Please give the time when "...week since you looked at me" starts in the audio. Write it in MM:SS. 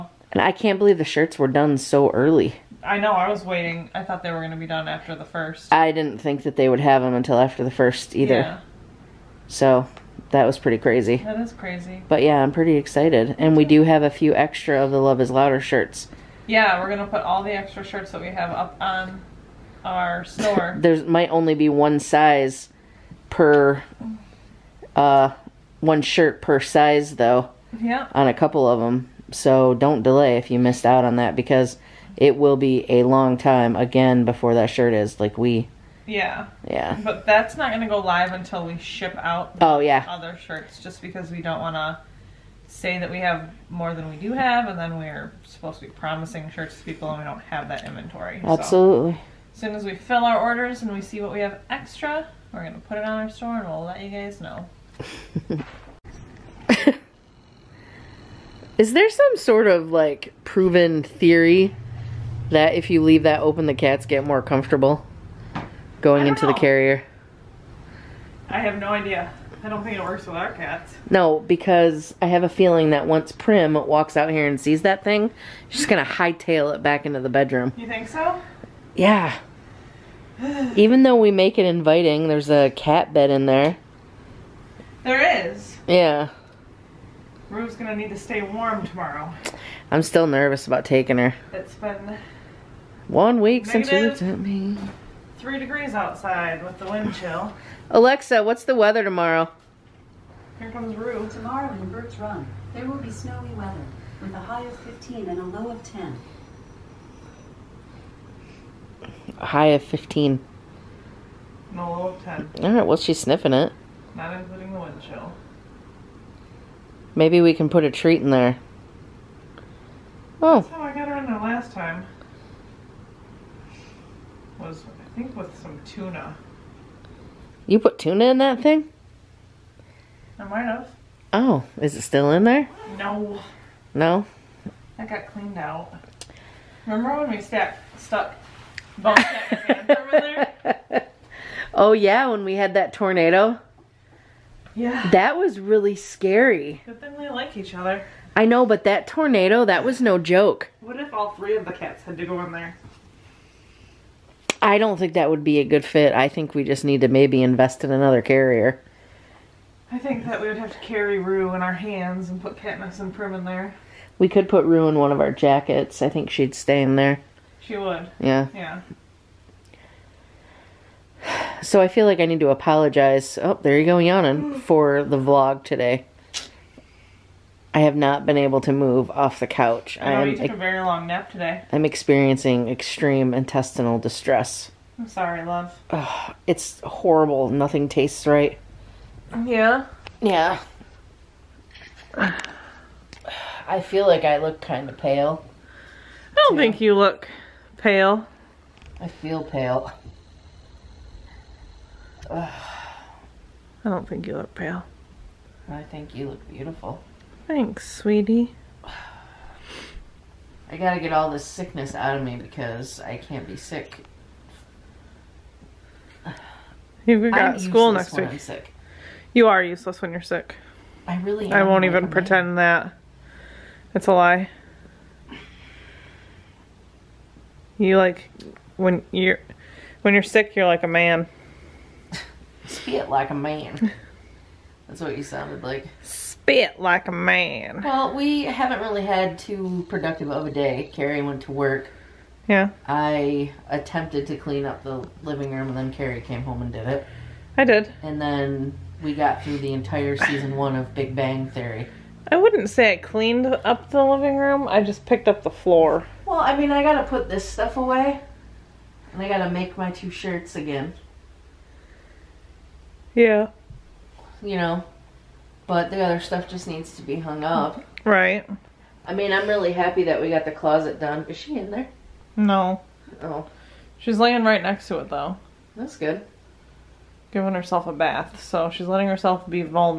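01:33.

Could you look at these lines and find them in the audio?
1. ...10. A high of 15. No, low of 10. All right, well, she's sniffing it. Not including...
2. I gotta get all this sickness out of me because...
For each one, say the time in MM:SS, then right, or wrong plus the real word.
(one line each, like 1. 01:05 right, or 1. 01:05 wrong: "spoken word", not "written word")
1. 01:45 right
2. 03:30 right.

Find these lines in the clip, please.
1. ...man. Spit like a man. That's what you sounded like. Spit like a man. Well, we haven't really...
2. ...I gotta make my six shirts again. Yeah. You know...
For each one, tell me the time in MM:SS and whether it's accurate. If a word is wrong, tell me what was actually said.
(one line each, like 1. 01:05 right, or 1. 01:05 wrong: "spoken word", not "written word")
1. 03:50 right
2. 04:19 wrong: "two", not "six".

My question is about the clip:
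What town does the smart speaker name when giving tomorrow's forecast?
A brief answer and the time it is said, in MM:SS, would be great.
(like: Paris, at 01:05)
Birch Run, at 01:41.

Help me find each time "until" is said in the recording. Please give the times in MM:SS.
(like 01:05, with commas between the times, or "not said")
00:07, 00:38.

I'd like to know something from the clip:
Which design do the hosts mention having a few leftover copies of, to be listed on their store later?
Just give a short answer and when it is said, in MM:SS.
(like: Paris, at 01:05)
Love is Louder, at 00:15.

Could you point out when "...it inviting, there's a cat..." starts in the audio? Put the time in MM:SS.
01:21.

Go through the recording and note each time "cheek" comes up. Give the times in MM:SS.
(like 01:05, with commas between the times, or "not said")
not said.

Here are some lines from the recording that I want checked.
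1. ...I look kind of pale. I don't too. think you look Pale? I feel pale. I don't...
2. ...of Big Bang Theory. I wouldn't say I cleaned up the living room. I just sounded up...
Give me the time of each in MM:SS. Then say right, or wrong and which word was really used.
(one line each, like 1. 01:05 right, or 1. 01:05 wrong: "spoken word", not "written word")
1. 03:14 right
2. 04:10 wrong: "picked", not "sounded".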